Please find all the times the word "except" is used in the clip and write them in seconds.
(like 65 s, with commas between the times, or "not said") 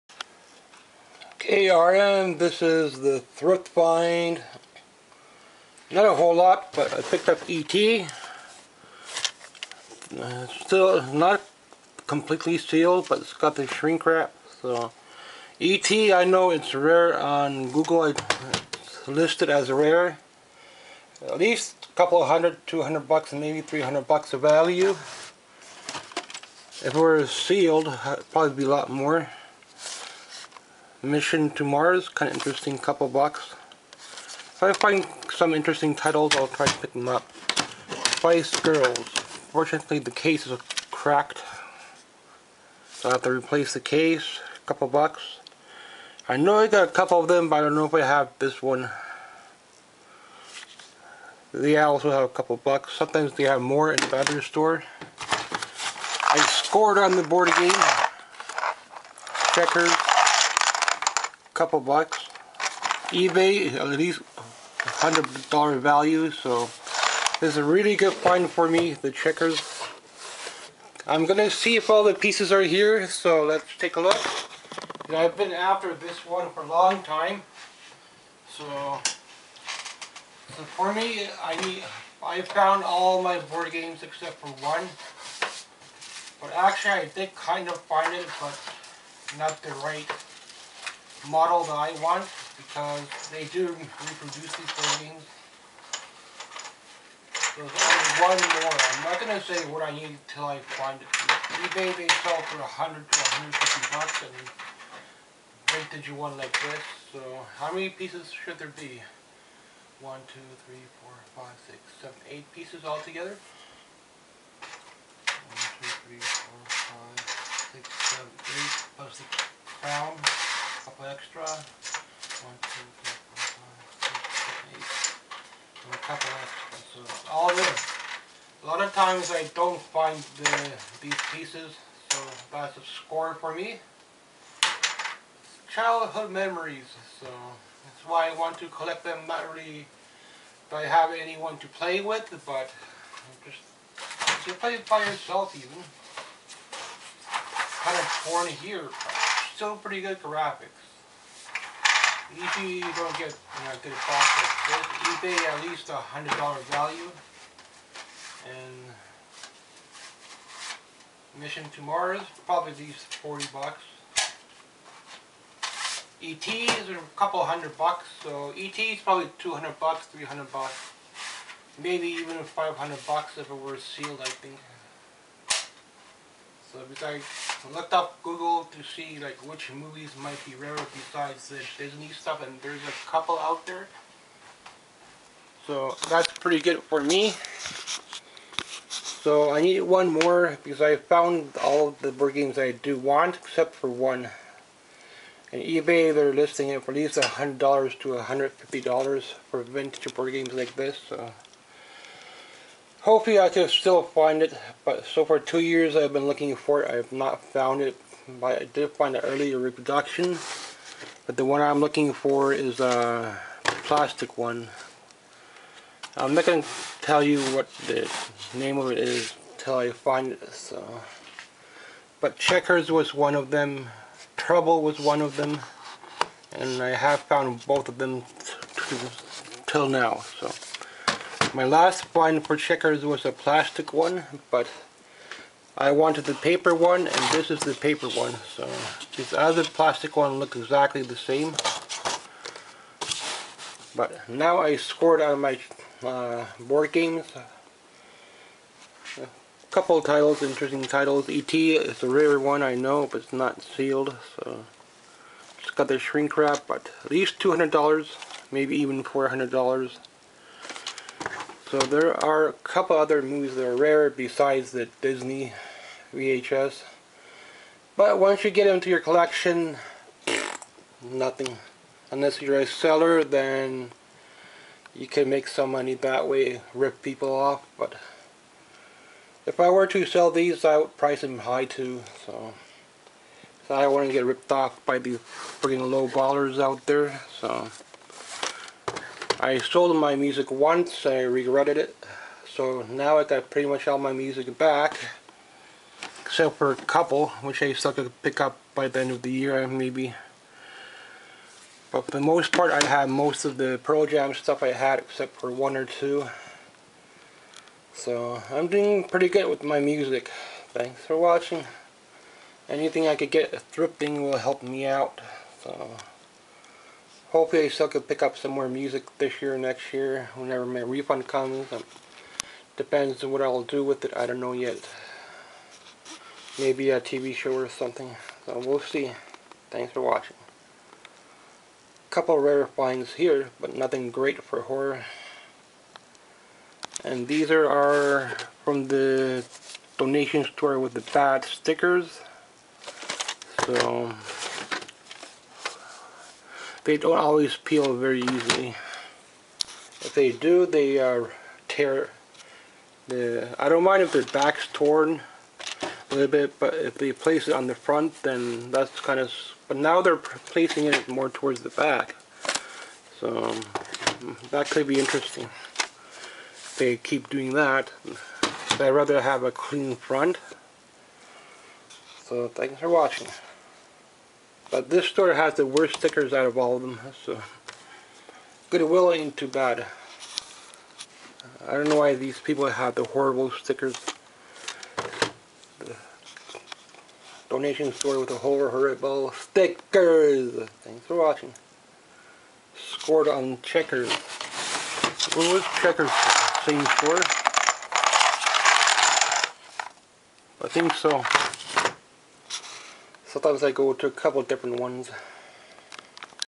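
84 s, 193 s, 296 s, 304 s.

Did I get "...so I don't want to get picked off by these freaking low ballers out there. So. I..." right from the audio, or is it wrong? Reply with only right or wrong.
wrong.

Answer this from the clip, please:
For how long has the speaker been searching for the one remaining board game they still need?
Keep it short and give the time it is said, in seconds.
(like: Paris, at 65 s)
2 years, at 205 s.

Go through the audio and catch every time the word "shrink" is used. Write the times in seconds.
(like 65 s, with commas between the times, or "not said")
13 s, 255 s.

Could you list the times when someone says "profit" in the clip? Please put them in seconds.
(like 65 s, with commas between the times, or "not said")
153 s.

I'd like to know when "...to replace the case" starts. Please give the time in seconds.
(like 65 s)
43 s.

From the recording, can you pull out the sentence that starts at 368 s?
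I'd rather have a clean front.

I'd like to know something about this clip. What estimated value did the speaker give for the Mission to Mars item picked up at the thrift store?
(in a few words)
$40.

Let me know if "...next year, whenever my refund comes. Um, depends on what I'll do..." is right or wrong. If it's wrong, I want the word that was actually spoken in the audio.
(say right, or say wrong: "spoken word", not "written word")
right.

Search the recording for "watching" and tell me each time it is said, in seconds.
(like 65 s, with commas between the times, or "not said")
311 s, 330 s, 372 s, 391 s.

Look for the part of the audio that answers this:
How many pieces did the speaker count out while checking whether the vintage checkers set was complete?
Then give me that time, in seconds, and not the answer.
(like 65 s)
112 s.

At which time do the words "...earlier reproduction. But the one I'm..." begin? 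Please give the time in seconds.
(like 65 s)
209 s.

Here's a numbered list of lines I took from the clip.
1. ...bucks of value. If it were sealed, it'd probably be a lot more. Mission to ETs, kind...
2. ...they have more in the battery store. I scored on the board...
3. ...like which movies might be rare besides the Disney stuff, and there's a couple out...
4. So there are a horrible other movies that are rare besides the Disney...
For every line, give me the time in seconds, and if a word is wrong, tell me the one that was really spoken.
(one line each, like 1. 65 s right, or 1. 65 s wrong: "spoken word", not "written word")
1. 24 s wrong: "Mars", not "ETs"
2. 53 s right
3. 179 s right
4. 261 s wrong: "couple", not "horrible".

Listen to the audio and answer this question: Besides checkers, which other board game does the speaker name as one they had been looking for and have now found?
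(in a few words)
Trouble.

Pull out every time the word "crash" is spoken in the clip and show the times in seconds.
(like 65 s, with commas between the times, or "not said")
not said.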